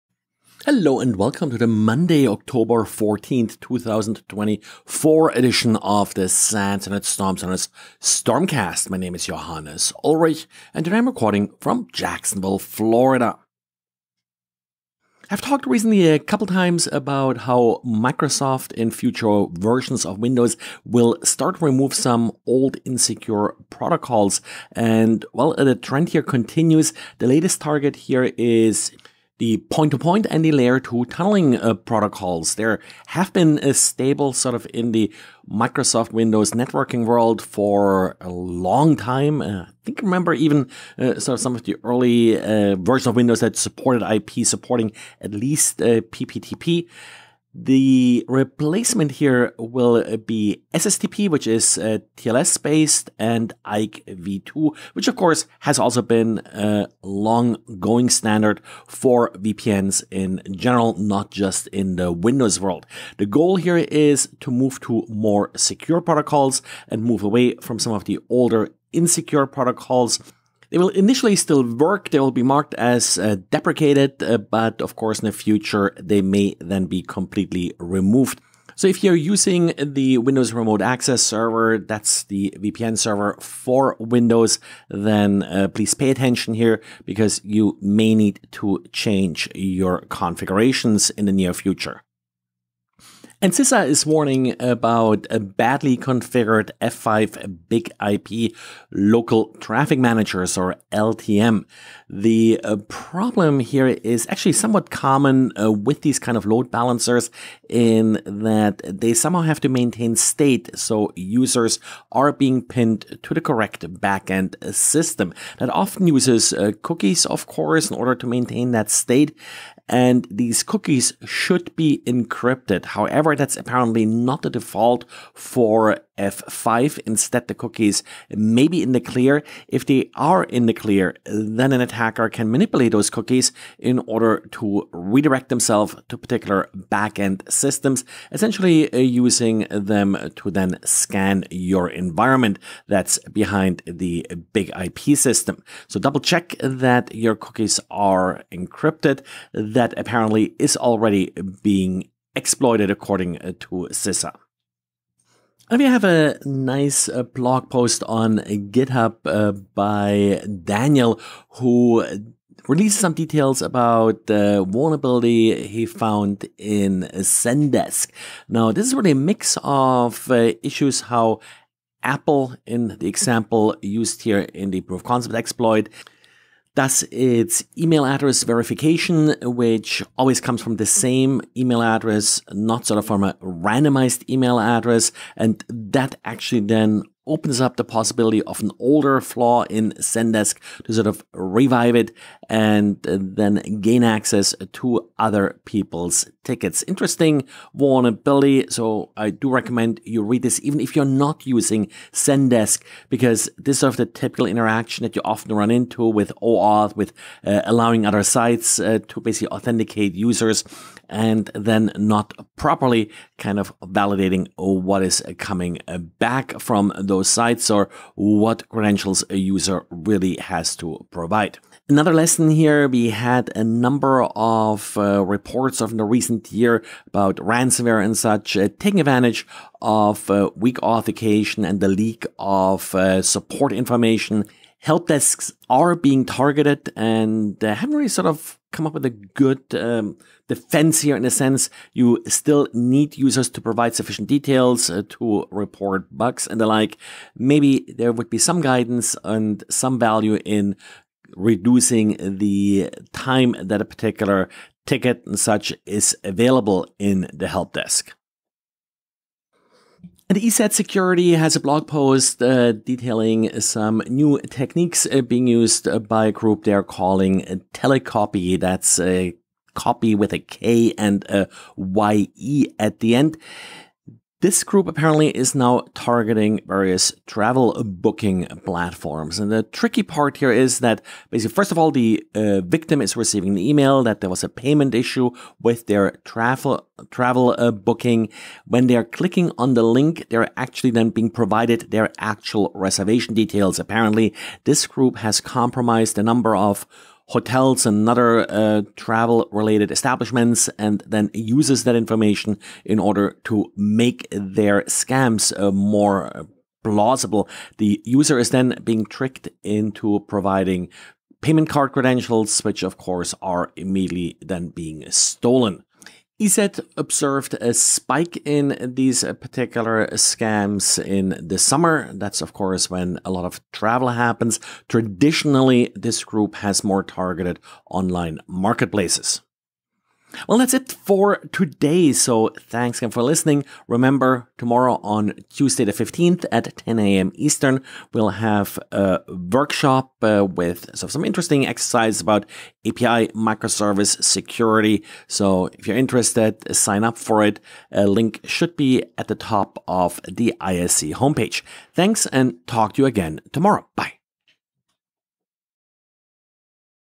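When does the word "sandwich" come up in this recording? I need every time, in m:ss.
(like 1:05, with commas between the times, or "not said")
not said.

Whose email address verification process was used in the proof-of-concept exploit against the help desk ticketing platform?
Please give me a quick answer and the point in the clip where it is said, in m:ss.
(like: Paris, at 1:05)
Apple, at 2:52.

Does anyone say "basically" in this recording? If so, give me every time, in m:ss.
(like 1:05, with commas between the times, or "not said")
3:29, 4:41.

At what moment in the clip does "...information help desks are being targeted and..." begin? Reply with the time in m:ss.
3:53.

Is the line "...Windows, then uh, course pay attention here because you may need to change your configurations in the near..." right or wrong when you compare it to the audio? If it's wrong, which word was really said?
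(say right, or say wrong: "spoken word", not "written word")
wrong: "please", not "course".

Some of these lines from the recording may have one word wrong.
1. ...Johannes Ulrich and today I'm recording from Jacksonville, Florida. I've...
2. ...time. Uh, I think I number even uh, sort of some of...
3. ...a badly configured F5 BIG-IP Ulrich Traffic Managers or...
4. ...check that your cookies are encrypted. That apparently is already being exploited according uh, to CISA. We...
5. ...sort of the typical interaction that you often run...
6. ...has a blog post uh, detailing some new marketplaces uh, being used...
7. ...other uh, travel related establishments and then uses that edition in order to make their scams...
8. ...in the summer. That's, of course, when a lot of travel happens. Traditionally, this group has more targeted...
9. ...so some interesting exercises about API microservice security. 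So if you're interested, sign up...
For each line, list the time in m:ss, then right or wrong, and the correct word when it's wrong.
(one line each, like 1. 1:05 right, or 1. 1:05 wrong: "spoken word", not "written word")
1. 0:09 right
2. 0:38 wrong: "remember", not "number"
3. 1:35 wrong: "Local", not "Ulrich"
4. 2:26 right
5. 3:23 right
6. 4:21 wrong: "techniques", not "marketplaces"
7. 4:58 wrong: "information", not "edition"
8. 5:21 right
9. 5:40 right.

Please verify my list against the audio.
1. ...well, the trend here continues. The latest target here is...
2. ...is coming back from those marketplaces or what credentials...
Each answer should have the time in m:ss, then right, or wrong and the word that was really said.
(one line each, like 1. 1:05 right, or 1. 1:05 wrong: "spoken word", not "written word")
1. 0:25 right
2. 3:35 wrong: "sites", not "marketplaces".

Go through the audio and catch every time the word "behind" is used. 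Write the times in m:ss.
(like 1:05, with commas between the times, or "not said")
2:23.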